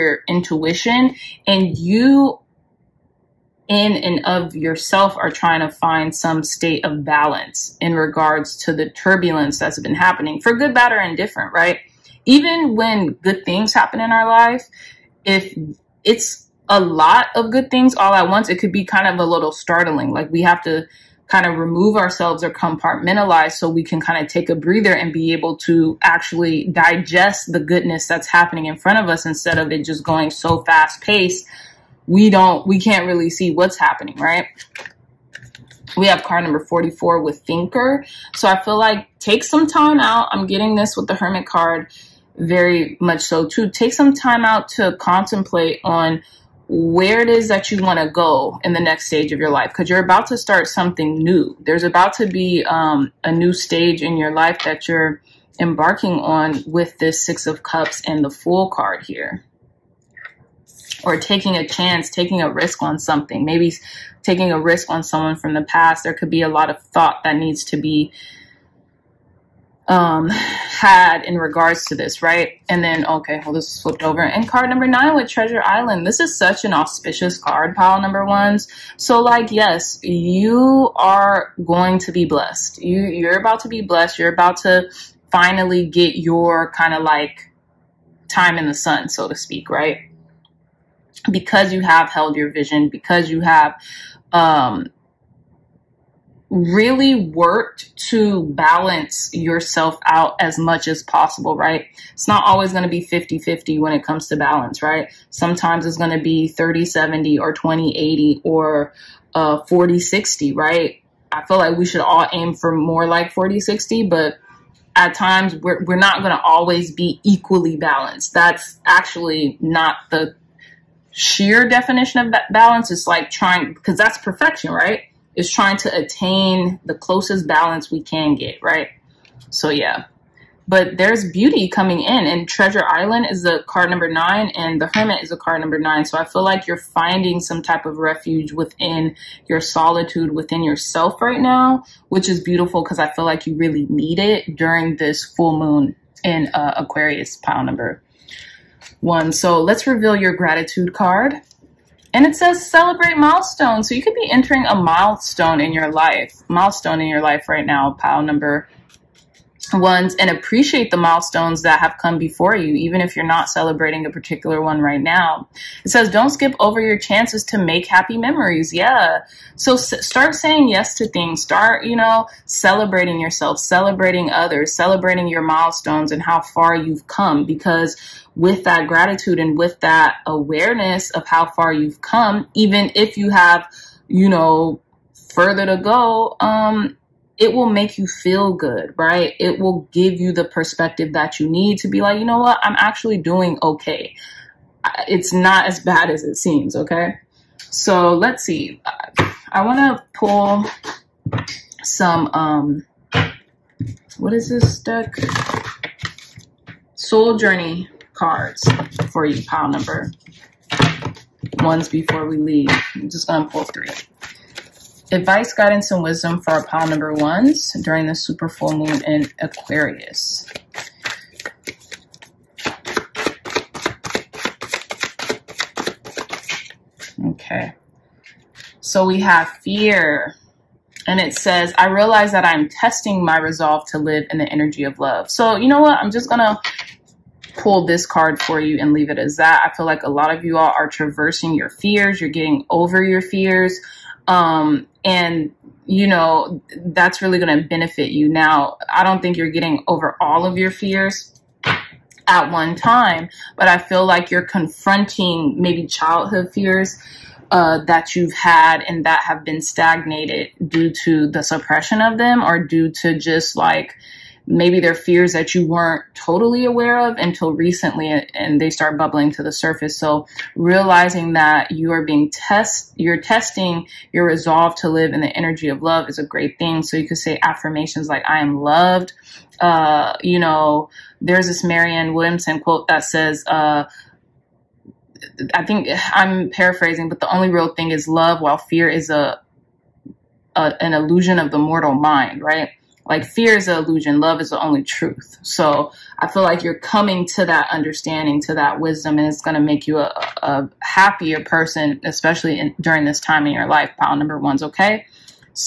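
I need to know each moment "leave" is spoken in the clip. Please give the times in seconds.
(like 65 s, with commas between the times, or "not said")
212 s, 238 s.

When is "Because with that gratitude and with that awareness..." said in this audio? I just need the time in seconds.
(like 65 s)
177 s.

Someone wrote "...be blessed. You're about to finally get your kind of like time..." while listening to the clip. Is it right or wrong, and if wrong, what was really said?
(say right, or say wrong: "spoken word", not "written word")
right.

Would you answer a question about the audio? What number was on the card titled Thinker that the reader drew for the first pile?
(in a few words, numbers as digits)
44.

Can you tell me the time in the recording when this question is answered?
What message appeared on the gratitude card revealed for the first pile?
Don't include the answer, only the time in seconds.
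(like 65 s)
152 s.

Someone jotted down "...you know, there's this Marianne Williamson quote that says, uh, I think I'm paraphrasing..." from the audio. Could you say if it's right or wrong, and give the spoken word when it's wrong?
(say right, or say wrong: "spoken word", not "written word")
right.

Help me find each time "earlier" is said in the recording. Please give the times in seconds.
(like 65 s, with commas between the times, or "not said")
not said.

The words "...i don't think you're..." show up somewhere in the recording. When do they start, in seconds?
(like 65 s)
248 s.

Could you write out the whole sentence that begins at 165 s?
It says, don't skip over your chances to make happy memories.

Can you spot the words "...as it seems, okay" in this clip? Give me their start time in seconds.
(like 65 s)
196 s.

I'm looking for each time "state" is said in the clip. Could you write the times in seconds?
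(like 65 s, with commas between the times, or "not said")
6 s.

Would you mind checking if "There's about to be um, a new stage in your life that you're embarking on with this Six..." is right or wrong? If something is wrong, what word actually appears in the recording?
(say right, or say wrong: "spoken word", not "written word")
right.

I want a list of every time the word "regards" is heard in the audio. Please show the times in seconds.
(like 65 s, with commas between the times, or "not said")
7 s, 71 s.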